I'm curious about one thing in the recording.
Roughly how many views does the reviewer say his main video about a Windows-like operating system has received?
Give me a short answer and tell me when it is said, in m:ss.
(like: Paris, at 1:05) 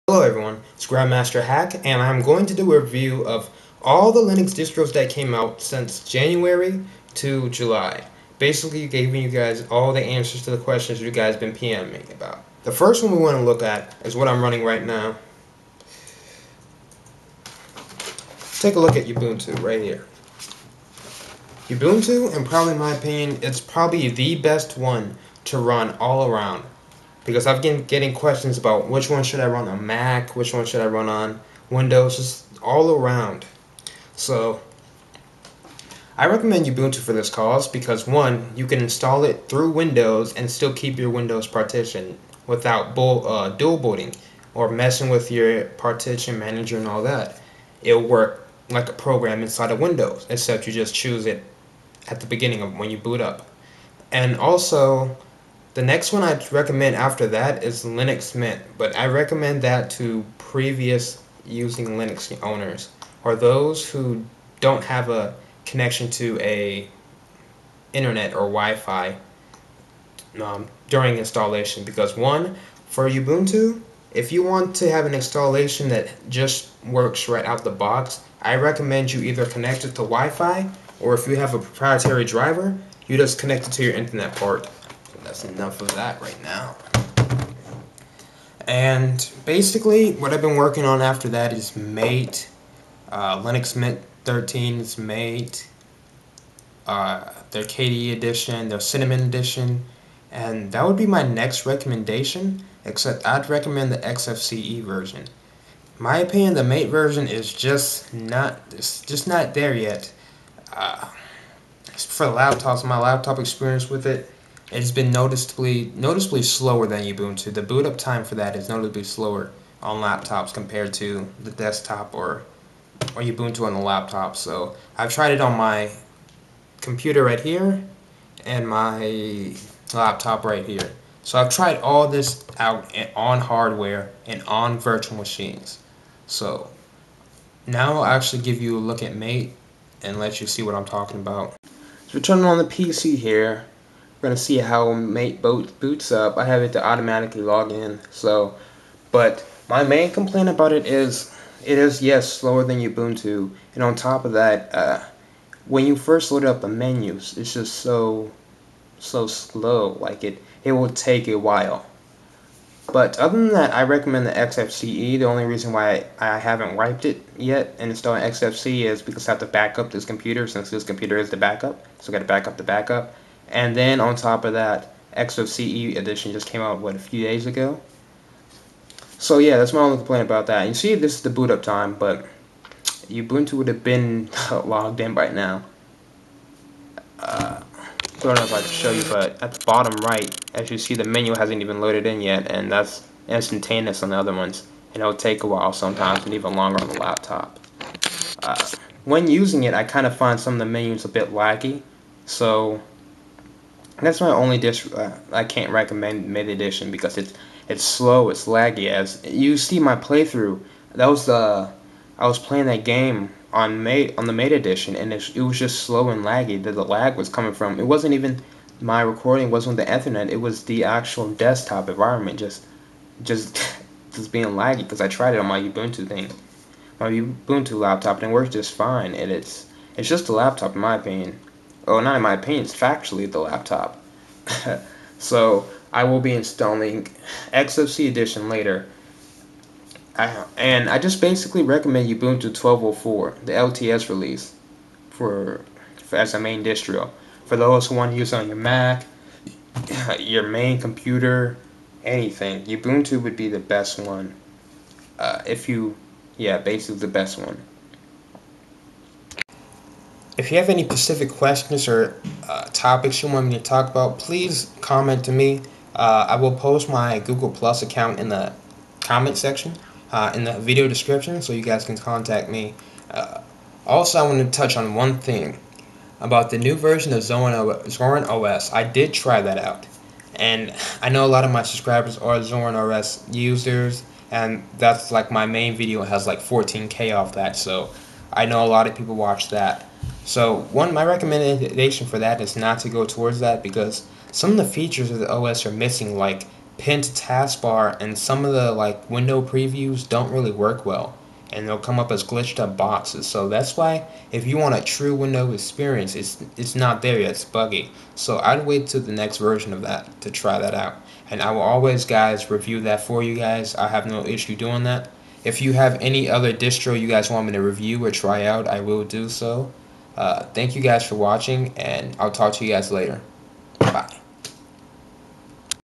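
14k, at 4:46.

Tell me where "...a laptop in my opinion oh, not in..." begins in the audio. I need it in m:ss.
3:50.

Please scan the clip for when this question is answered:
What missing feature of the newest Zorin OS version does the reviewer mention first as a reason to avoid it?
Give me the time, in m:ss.
4:56.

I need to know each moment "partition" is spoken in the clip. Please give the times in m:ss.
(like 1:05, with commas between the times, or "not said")
0:41, 0:45.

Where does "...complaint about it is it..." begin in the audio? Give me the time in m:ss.
2:30.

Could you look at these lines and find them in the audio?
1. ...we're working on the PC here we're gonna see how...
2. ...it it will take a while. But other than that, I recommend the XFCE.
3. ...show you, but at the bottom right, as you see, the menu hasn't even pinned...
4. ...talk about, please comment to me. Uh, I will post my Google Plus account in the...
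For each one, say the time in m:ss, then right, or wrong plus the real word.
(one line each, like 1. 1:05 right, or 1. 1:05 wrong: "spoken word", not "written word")
1. 2:22 wrong: "turning", not "working"
2. 2:40 right
3. 3:08 wrong: "loaded", not "pinned"
4. 4:23 right.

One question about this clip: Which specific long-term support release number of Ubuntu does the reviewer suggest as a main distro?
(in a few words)
12.04.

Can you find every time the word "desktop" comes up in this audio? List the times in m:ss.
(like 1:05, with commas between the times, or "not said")
2:01, 3:41.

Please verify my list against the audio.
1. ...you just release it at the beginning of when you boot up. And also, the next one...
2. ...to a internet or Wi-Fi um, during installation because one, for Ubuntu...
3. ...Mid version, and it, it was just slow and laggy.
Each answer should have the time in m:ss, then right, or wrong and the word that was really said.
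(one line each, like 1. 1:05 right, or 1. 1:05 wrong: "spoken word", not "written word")
1. 0:50 wrong: "choose", not "release"
2. 1:06 right
3. 3:34 wrong: "edition", not "version".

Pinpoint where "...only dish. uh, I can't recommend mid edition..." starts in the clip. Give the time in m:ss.
3:24.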